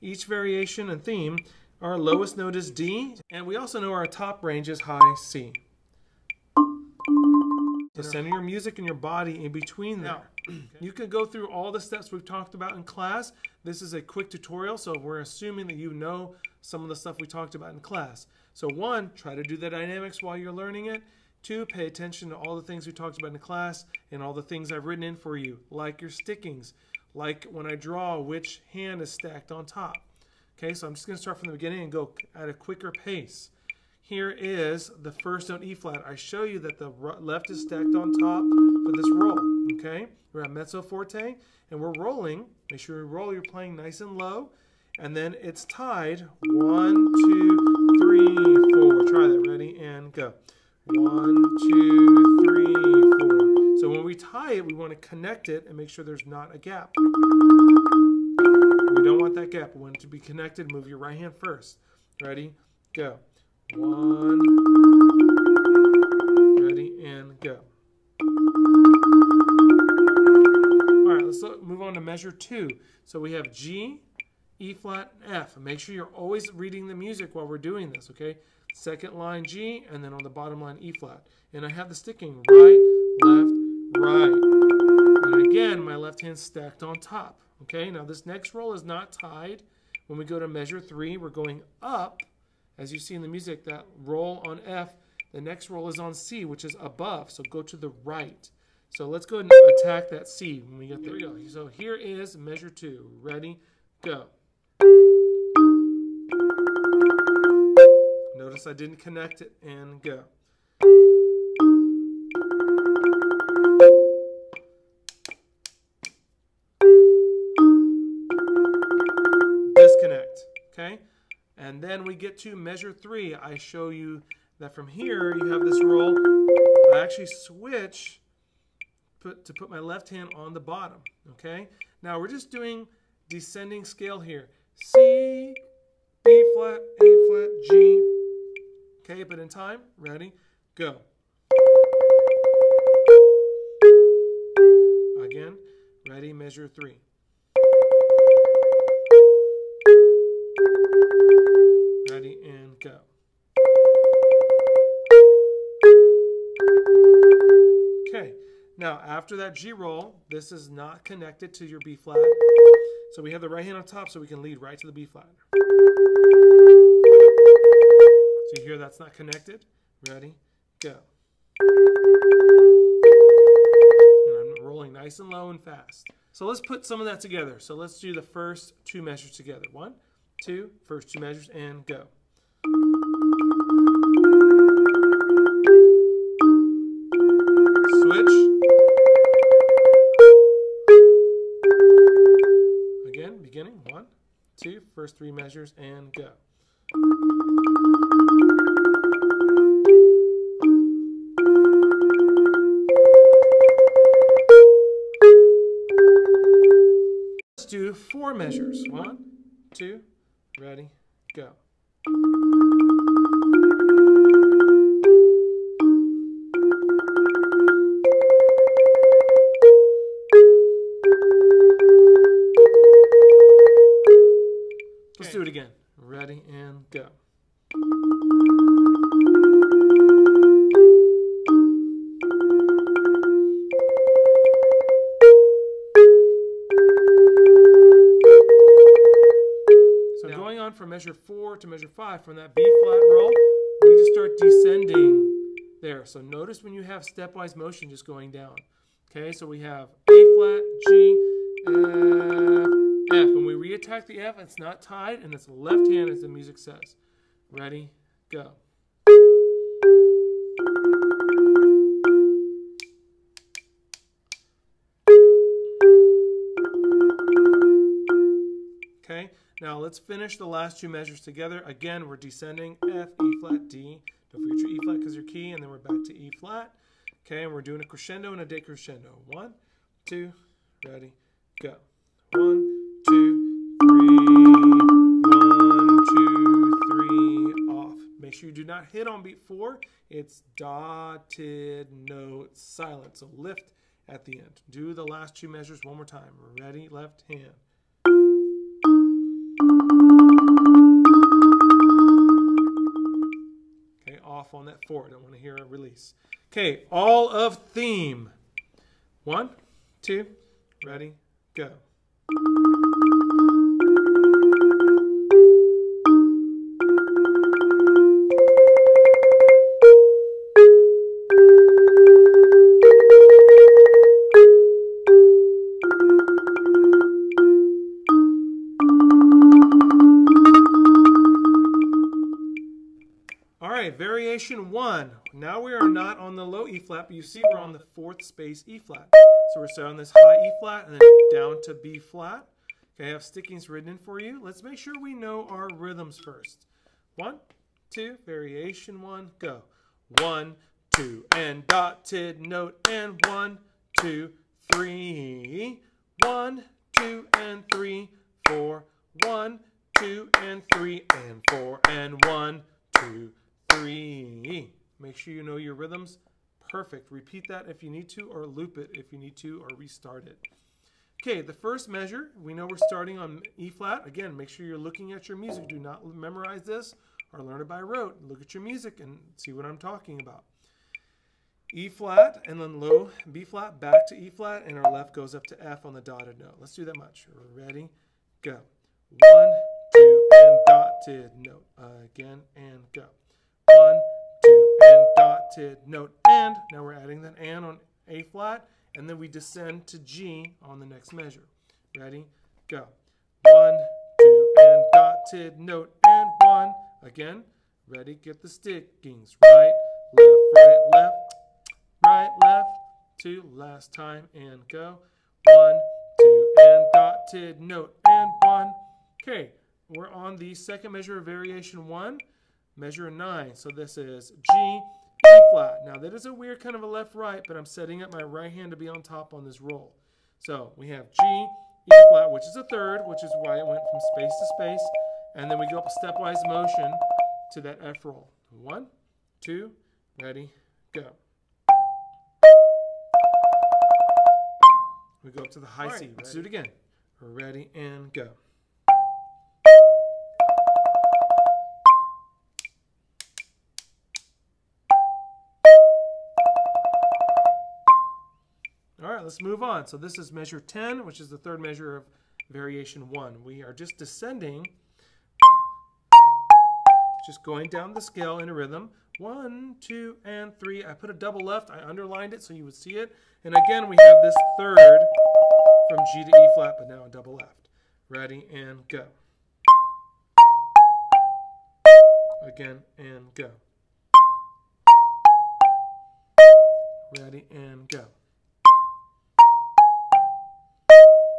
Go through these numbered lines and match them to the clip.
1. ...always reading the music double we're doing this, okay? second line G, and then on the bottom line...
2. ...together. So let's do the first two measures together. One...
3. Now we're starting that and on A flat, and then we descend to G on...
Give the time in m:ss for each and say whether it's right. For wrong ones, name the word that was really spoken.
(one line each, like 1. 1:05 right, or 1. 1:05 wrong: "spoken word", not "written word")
1. 1:16 wrong: "while", not "double"
2. 2:57 right
3. 6:36 wrong: "adding", not "starting".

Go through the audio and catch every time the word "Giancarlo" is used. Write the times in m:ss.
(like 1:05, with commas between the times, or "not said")
not said.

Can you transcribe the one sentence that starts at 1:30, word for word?
When we go to measure three, we're going up.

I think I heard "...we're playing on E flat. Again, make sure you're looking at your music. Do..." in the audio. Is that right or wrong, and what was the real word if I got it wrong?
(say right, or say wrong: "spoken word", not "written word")
wrong: "starting", not "playing".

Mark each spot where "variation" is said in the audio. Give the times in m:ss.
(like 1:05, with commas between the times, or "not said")
0:00, 5:34, 5:48, 7:01, 7:42.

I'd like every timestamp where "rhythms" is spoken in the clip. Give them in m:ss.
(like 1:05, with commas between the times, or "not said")
5:45, 6:05, 7:48.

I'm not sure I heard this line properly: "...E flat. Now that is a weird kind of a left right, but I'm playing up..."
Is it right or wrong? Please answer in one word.
wrong.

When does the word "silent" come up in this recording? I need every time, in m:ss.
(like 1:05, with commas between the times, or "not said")
4:52.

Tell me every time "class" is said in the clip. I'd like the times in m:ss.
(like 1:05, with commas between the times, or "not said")
0:12, 0:17, 0:23.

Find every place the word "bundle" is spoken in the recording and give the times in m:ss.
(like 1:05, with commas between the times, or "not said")
not said.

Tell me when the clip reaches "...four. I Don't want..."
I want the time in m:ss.
5:04.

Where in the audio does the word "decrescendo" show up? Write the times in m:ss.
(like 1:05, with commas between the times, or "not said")
4:38.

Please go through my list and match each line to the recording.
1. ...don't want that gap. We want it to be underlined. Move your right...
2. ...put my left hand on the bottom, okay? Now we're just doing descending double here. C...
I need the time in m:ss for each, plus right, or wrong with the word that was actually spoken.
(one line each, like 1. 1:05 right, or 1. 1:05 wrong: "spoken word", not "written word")
1. 0:59 wrong: "connected", not "underlined"
2. 2:09 wrong: "scale", not "double".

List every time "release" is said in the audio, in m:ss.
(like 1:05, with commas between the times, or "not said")
5:05.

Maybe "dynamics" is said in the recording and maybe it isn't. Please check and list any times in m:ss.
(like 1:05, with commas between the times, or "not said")
0:19.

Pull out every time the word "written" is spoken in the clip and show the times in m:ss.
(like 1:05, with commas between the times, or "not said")
0:24, 5:43.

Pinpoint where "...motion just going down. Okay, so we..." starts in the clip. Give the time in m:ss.
4:07.